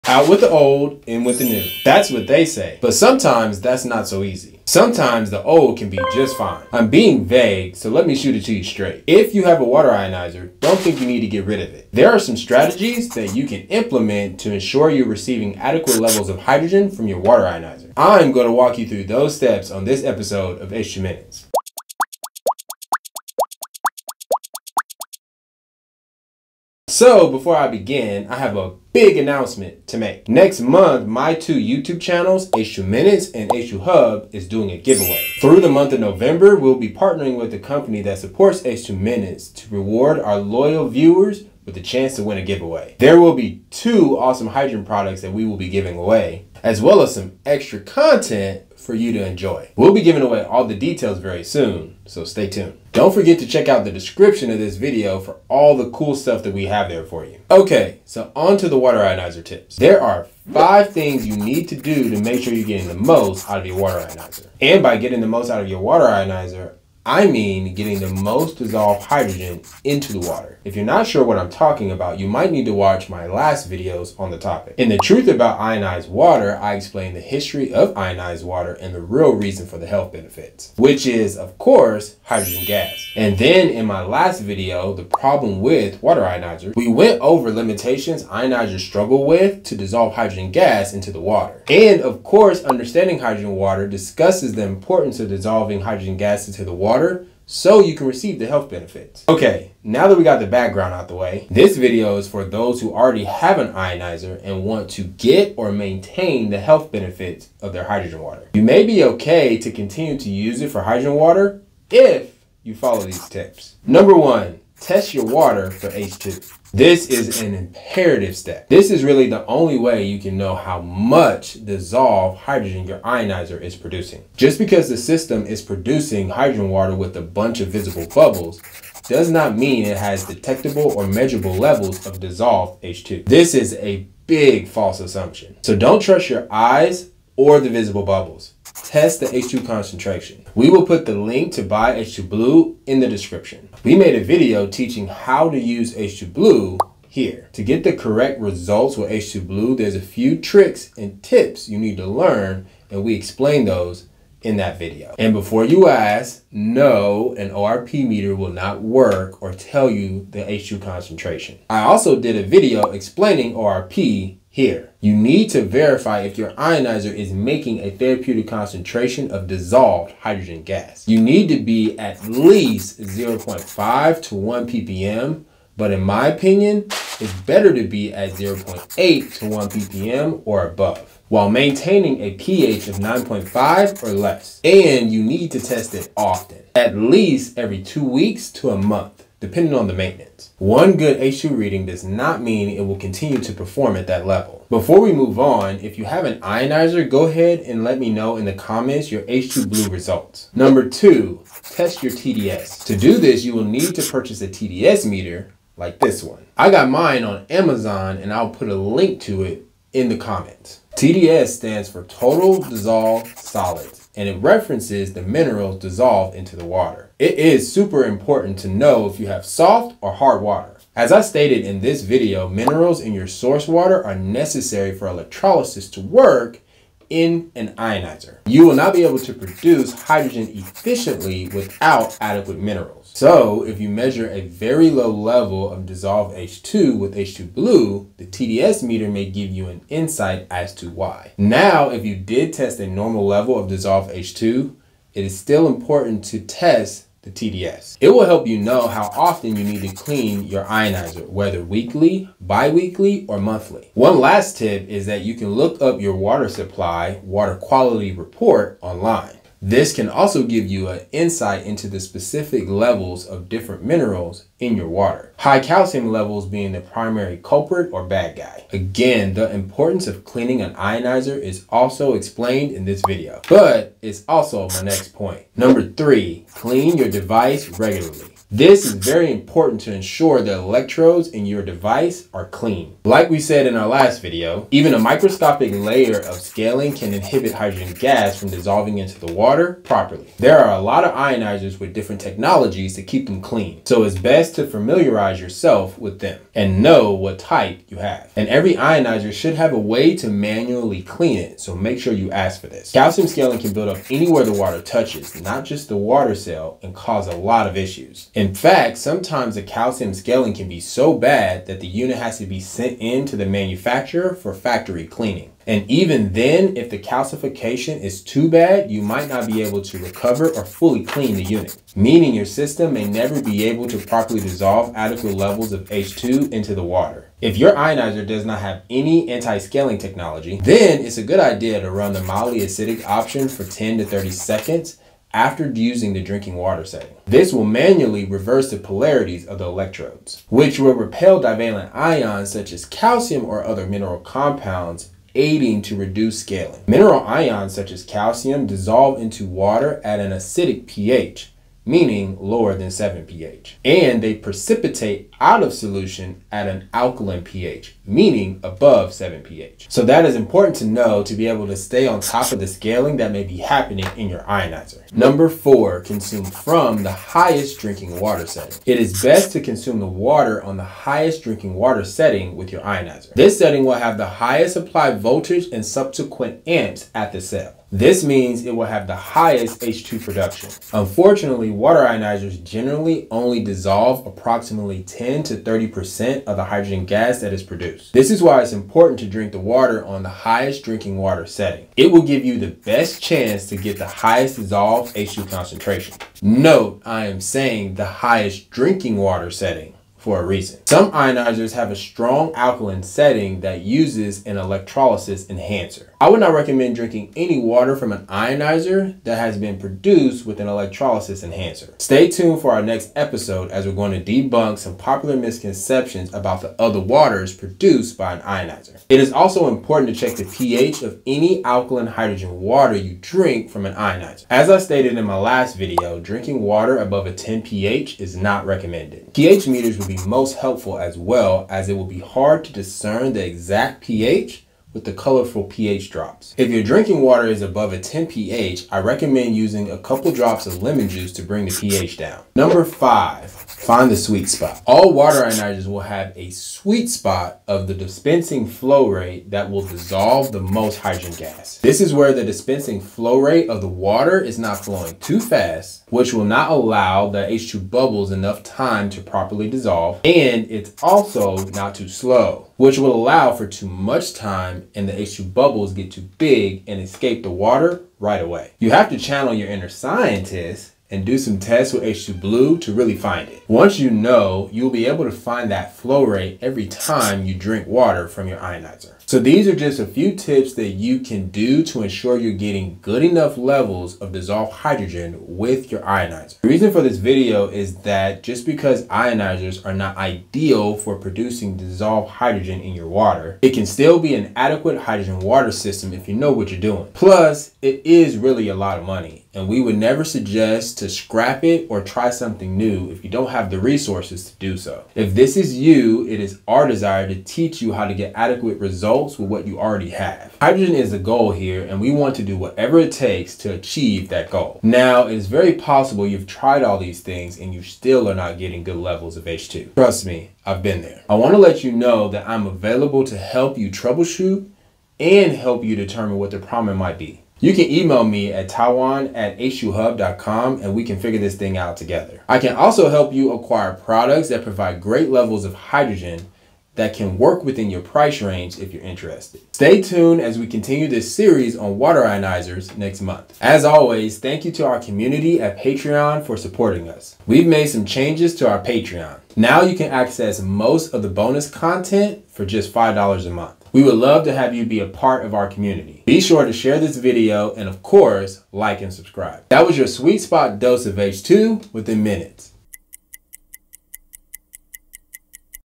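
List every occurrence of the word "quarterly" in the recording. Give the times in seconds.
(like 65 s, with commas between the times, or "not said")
not said.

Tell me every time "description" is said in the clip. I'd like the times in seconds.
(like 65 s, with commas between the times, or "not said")
53 s, 143 s.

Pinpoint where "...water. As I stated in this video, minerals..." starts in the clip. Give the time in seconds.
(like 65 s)
220 s.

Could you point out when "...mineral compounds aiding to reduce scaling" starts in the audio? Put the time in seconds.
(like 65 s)
343 s.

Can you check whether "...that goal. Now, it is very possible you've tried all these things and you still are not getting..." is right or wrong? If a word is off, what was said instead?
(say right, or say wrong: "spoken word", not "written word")
right.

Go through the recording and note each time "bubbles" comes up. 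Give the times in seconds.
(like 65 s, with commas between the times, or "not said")
128 s, 138 s, 457 s, 465 s.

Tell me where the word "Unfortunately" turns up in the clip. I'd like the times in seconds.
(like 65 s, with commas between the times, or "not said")
380 s.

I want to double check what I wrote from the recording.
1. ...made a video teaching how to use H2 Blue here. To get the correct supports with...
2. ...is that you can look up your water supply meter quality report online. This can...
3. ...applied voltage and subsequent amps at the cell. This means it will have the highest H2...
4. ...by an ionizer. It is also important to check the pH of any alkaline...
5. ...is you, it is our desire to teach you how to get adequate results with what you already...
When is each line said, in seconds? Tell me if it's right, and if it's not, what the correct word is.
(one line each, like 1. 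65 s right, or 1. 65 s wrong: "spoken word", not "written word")
1. 143 s wrong: "results", not "supports"
2. 254 s wrong: "water", not "meter"
3. 374 s right
4. 418 s right
5. 505 s right.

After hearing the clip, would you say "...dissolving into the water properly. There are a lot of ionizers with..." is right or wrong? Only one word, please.
right.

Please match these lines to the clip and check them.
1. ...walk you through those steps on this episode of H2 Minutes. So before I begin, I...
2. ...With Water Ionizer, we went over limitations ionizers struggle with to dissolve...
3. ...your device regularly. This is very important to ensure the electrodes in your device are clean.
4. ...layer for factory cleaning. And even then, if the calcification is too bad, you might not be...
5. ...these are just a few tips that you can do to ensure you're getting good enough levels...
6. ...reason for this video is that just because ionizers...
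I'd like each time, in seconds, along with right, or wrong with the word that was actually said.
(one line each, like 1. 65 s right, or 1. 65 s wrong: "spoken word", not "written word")
1. 18 s right
2. 85 s right
3. 276 s right
4. 313 s wrong: "manufacturer", not "layer"
5. 479 s right
6. 486 s right.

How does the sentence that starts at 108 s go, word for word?
You may be okay to continue to use it for hydrogen water if you follow these tips.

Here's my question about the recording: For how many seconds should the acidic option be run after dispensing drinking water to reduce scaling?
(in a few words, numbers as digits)
10 to 30 seconds.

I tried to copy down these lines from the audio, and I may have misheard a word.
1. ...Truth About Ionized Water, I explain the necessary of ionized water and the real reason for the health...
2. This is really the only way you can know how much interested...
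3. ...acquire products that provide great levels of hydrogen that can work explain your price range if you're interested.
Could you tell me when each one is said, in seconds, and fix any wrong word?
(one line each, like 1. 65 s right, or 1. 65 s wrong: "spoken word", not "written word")
1. 74 s wrong: "history", not "necessary"
2. 118 s wrong: "dissolved", not "interested"
3. 533 s wrong: "within", not "explain".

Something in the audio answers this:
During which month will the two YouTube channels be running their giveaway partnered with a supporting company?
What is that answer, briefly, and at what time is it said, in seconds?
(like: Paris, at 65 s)
November, at 36 s.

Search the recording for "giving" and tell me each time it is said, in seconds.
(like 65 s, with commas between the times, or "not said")
45 s, 50 s.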